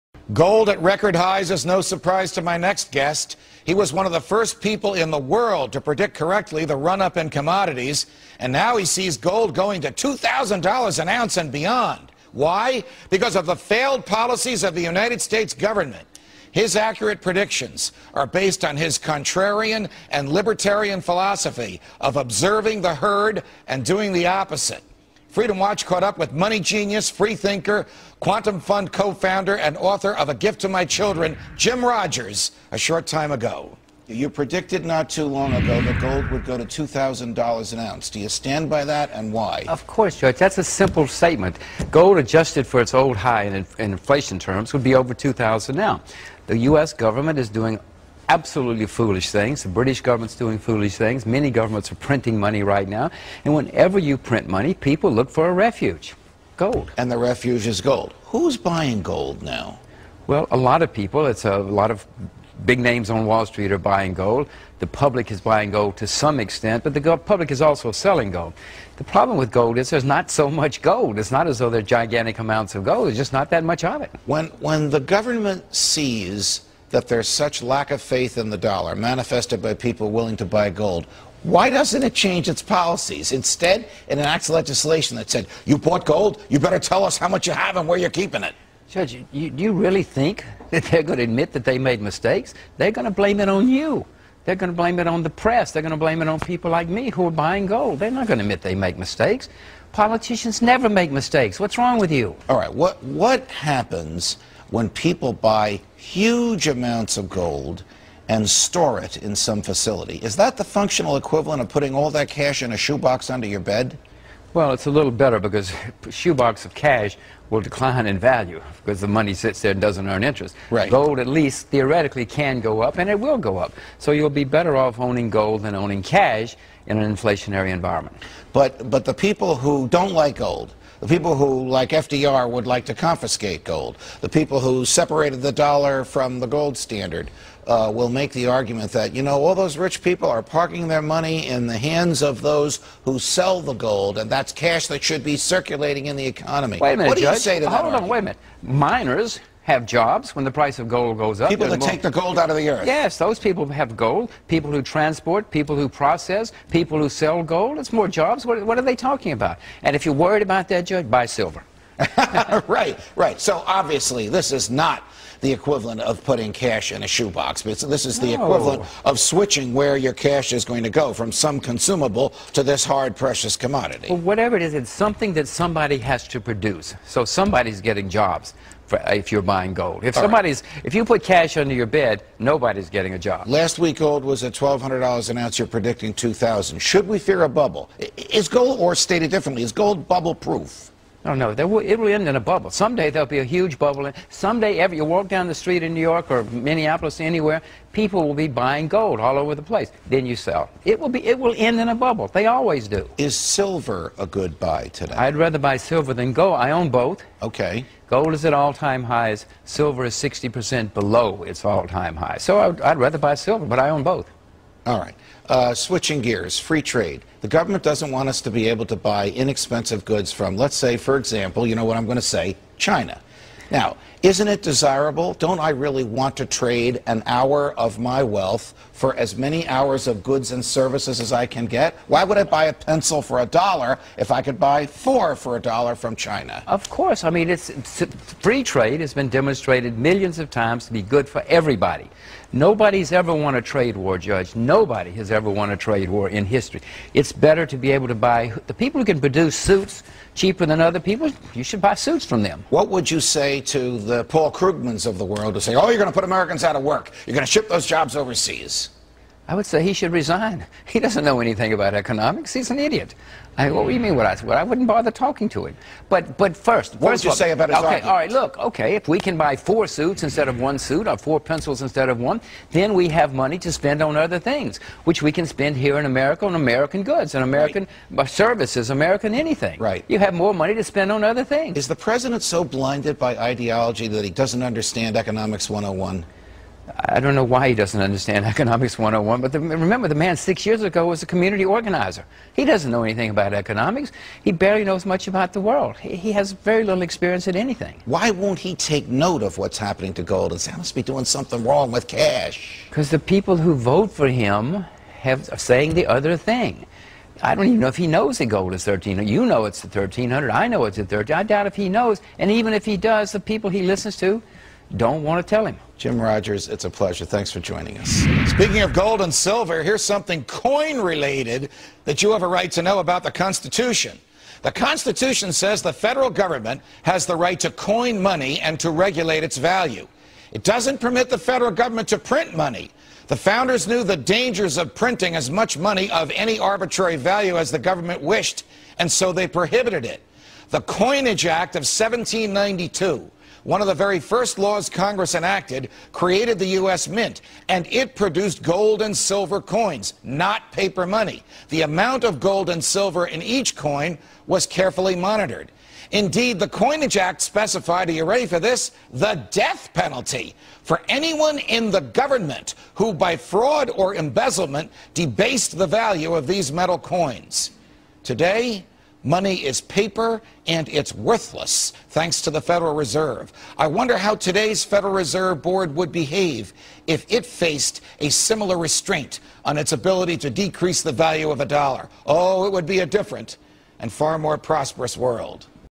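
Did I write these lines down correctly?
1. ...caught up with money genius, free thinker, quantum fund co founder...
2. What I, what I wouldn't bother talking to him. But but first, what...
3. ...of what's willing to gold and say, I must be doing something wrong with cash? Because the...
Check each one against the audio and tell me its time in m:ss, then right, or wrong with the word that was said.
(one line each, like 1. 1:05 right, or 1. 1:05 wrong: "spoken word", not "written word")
1. 0:25 right
2. 4:24 right
3. 4:59 wrong: "happening", not "willing".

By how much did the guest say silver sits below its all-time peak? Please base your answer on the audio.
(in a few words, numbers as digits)
60%.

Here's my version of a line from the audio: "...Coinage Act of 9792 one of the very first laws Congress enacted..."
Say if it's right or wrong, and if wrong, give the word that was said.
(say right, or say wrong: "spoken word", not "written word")
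wrong: "1792", not "9792".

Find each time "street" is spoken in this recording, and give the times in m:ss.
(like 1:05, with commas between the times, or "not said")
1:03, 3:15.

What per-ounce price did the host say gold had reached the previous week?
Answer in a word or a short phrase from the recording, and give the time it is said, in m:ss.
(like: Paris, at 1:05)
$1,200, at 3:04.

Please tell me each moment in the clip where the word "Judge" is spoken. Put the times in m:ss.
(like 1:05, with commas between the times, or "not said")
0:40, 1:28, 2:27, 2:40, 4:04.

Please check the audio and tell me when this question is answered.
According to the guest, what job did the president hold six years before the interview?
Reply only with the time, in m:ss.
4:51.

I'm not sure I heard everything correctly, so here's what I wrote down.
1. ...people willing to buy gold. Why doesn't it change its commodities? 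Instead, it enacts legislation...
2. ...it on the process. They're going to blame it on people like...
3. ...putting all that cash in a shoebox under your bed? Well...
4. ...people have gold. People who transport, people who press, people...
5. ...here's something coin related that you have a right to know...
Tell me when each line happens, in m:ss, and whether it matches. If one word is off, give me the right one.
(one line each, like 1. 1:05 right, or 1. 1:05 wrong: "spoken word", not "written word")
1. 1:19 wrong: "policies", not "commodities"
2. 1:34 wrong: "press", not "process"
3. 1:51 right
4. 2:33 wrong: "process", not "press"
5. 5:19 right.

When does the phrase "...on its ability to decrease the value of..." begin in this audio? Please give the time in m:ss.
6:19.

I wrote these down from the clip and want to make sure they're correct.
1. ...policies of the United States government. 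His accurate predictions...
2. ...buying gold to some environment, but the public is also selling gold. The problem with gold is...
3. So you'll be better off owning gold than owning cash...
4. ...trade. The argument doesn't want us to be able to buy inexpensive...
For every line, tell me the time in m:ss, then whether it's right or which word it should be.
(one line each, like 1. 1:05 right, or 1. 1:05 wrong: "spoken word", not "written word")
1. 0:14 right
2. 1:05 wrong: "extent", not "environment"
3. 2:03 right
4. 3:36 wrong: "government", not "argument".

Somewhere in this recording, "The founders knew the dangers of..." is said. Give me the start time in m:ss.
5:33.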